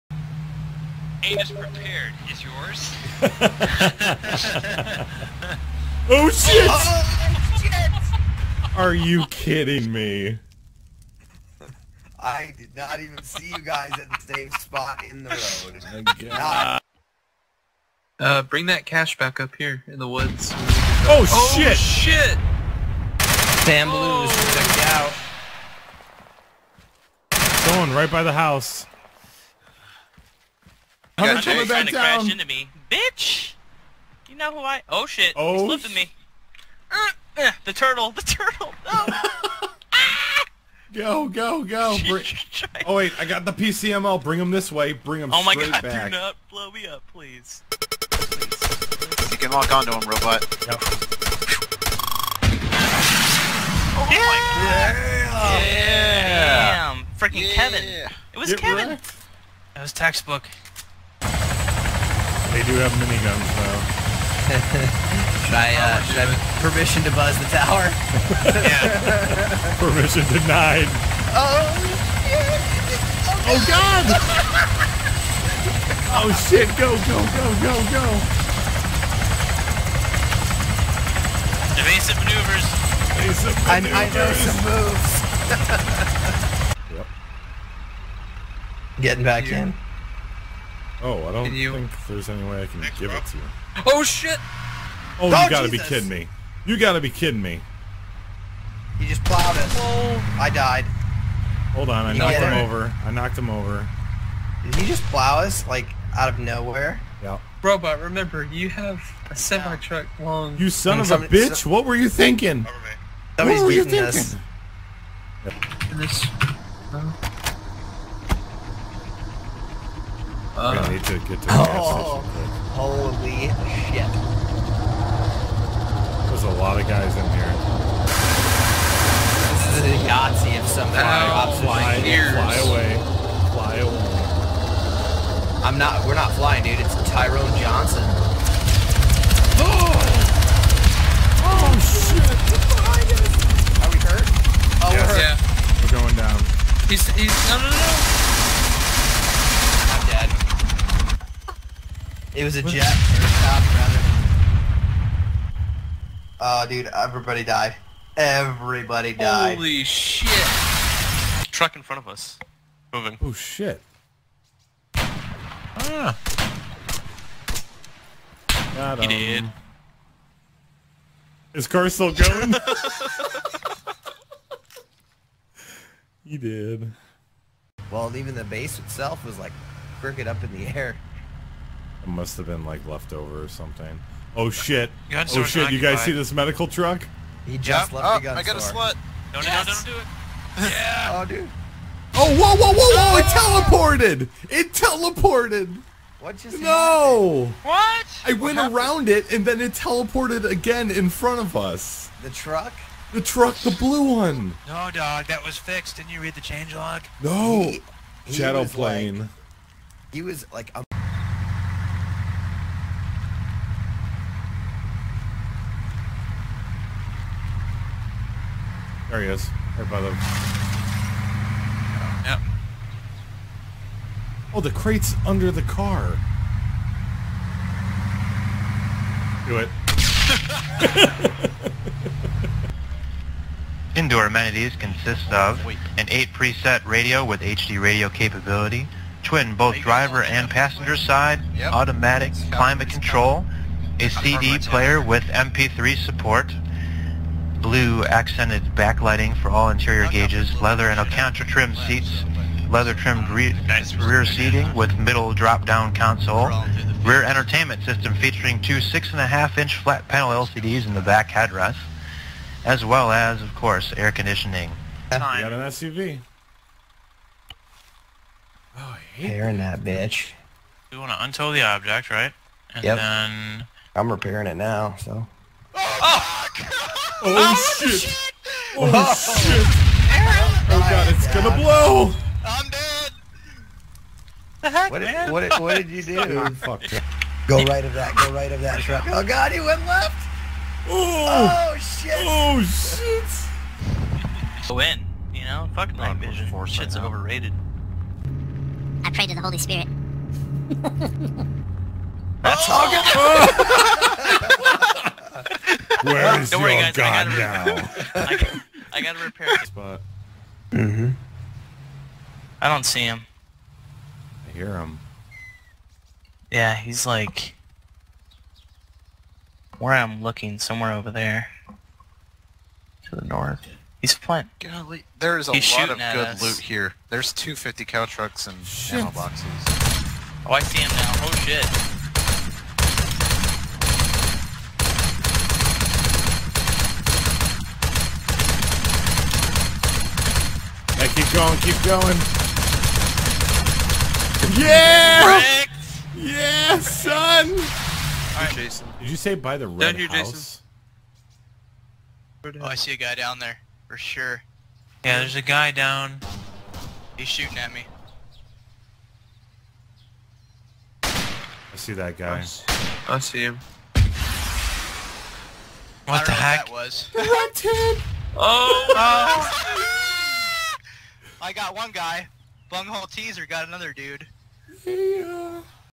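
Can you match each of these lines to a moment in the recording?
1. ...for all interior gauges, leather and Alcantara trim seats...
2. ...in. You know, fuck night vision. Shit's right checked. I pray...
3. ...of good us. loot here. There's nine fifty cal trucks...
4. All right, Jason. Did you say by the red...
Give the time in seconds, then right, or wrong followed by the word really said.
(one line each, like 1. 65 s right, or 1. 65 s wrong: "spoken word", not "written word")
1. 249 s right
2. 294 s wrong: "overrated", not "checked"
3. 325 s wrong: "two", not "nine"
4. 347 s right.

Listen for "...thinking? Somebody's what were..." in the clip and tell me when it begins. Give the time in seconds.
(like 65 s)
112 s.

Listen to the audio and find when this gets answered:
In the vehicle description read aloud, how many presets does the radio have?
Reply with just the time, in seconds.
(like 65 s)
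236 s.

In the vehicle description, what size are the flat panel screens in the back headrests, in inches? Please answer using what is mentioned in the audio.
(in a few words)
6.5.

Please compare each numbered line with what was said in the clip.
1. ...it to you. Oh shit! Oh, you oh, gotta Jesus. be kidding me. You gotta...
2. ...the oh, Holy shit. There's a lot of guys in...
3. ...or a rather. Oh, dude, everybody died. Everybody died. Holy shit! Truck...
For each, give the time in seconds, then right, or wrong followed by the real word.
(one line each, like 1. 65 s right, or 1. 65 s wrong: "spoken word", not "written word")
1. 93 s right
2. 121 s right
3. 152 s right.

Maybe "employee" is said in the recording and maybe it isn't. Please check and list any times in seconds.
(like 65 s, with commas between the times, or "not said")
not said.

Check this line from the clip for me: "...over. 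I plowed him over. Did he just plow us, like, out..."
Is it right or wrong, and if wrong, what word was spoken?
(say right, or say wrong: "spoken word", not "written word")
wrong: "knocked", not "plowed".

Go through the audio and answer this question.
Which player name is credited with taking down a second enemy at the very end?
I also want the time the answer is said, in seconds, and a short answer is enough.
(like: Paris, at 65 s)
Bunghole Teaser, at 372 s.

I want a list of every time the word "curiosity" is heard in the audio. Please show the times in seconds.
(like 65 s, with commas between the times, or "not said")
not said.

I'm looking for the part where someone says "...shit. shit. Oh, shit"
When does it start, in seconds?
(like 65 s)
277 s.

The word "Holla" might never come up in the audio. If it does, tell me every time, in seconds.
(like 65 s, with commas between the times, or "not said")
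not said.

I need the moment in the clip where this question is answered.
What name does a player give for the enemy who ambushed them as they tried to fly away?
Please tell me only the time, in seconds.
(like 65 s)
137 s.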